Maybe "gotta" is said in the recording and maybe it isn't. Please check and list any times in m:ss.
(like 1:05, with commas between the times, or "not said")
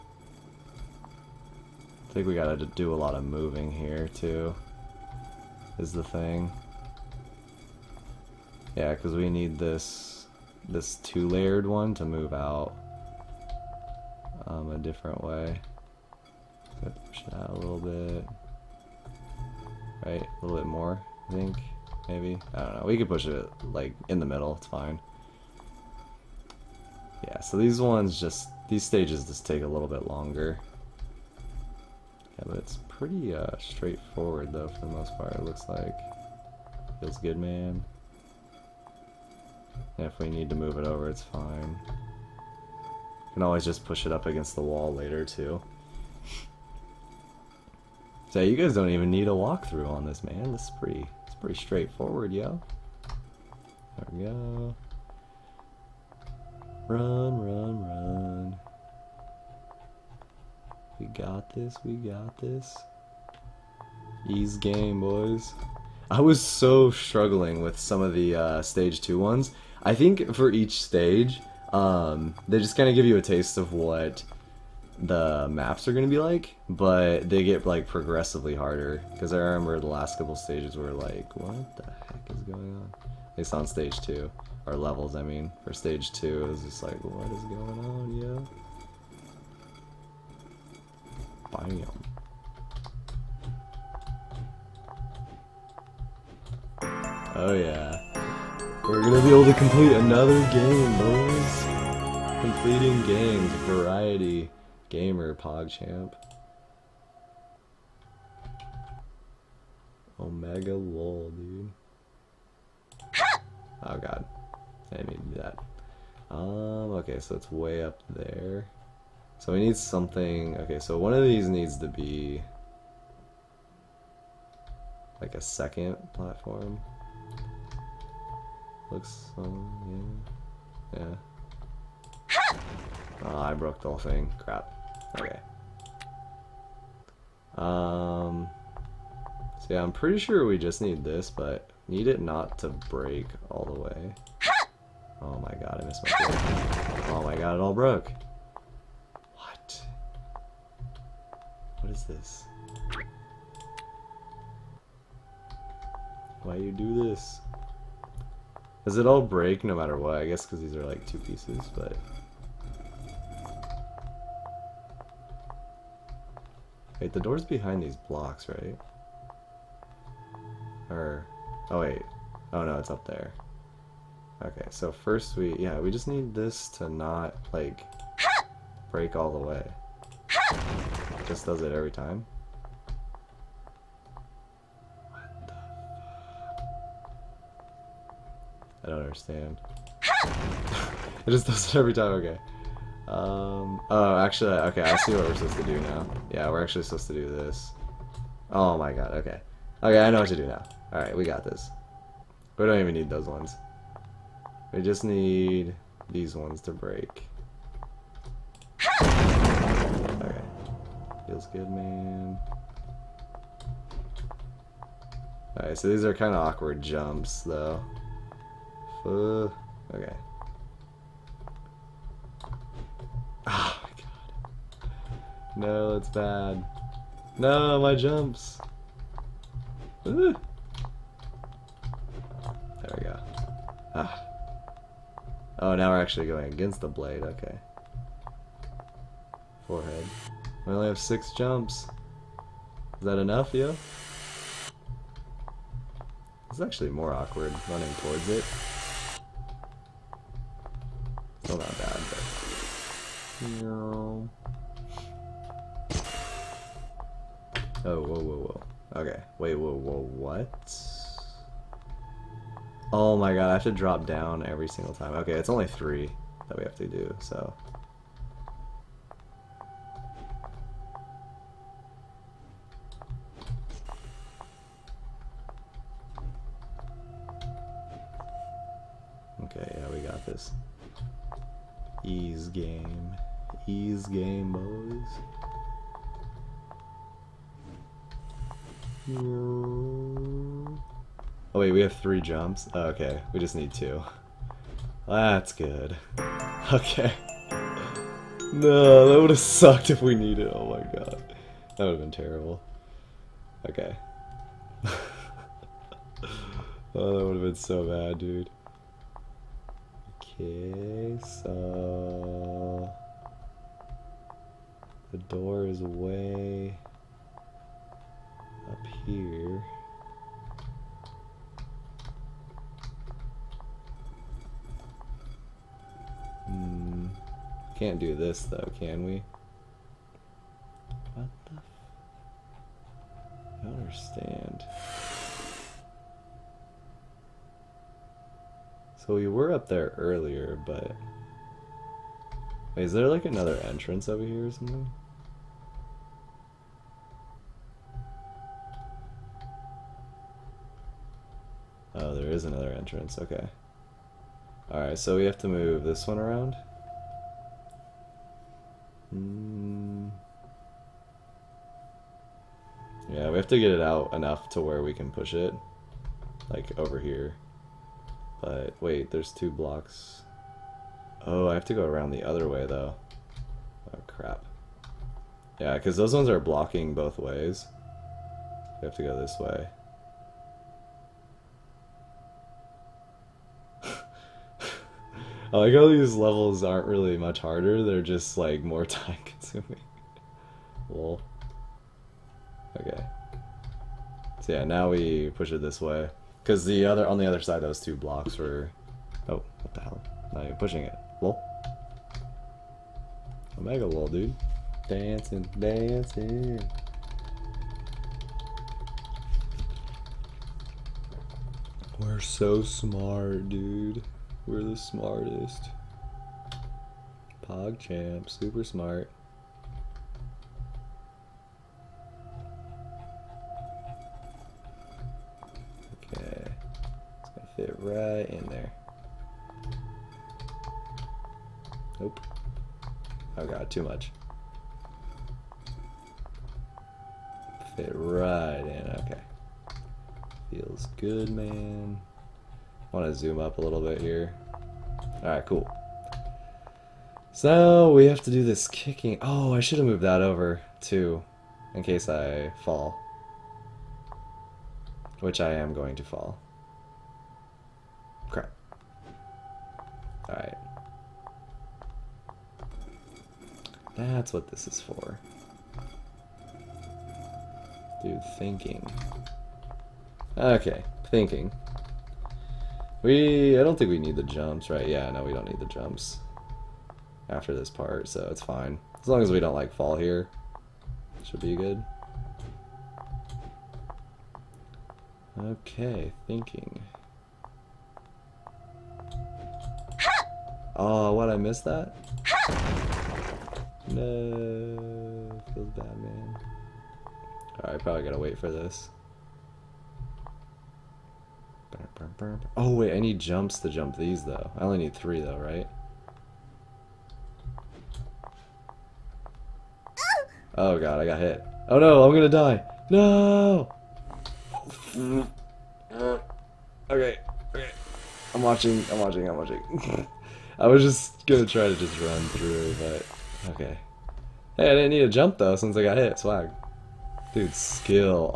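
0:02, 8:18.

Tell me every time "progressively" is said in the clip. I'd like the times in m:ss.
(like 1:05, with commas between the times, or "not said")
1:17.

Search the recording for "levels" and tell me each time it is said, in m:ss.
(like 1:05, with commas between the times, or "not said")
1:24, 6:26.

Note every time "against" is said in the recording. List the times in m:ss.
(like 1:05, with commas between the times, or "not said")
0:44, 3:56.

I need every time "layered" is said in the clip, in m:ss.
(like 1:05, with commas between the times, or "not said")
0:10.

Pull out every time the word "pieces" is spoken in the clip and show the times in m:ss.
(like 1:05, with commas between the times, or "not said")
2:41.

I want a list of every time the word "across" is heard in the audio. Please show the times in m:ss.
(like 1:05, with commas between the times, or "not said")
not said.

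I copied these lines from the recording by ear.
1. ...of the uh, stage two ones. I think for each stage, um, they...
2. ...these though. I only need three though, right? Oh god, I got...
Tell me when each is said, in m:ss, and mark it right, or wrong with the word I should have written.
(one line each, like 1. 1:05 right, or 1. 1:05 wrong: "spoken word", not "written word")
1. 1:08 right
2. 8:23 right.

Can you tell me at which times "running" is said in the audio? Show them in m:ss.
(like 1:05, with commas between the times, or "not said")
4:07.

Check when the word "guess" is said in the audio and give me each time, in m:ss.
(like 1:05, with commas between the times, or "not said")
2:40.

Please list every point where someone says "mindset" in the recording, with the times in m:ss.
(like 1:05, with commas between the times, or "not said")
not said.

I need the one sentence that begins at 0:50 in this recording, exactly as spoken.
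This is pretty, it's pretty straightforward, yo.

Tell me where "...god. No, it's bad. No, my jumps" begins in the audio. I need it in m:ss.
3:43.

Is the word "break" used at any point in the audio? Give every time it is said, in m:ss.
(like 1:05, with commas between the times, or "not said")
2:22, 2:26, 2:39, 2:58, 3:26.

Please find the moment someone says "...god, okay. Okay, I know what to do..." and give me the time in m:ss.
3:18.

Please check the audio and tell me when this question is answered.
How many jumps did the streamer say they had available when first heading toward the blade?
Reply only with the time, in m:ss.
4:00.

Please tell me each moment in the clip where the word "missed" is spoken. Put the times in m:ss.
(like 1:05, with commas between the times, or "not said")
2:25, 8:11.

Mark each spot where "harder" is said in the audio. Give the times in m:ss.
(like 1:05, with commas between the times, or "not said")
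1:18, 6:27.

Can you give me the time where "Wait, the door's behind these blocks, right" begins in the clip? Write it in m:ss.
2:46.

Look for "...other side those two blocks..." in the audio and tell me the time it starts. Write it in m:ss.
6:37.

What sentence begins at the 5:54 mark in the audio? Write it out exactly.
Alright, so we have to move this one around.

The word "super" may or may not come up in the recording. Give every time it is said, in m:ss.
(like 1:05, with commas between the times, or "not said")
6:58.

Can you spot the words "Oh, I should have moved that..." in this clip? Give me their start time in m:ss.
7:29.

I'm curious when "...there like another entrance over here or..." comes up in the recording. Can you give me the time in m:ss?
5:42.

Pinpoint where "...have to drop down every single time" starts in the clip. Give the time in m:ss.
4:23.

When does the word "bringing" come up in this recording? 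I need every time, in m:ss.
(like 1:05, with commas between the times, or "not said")
not said.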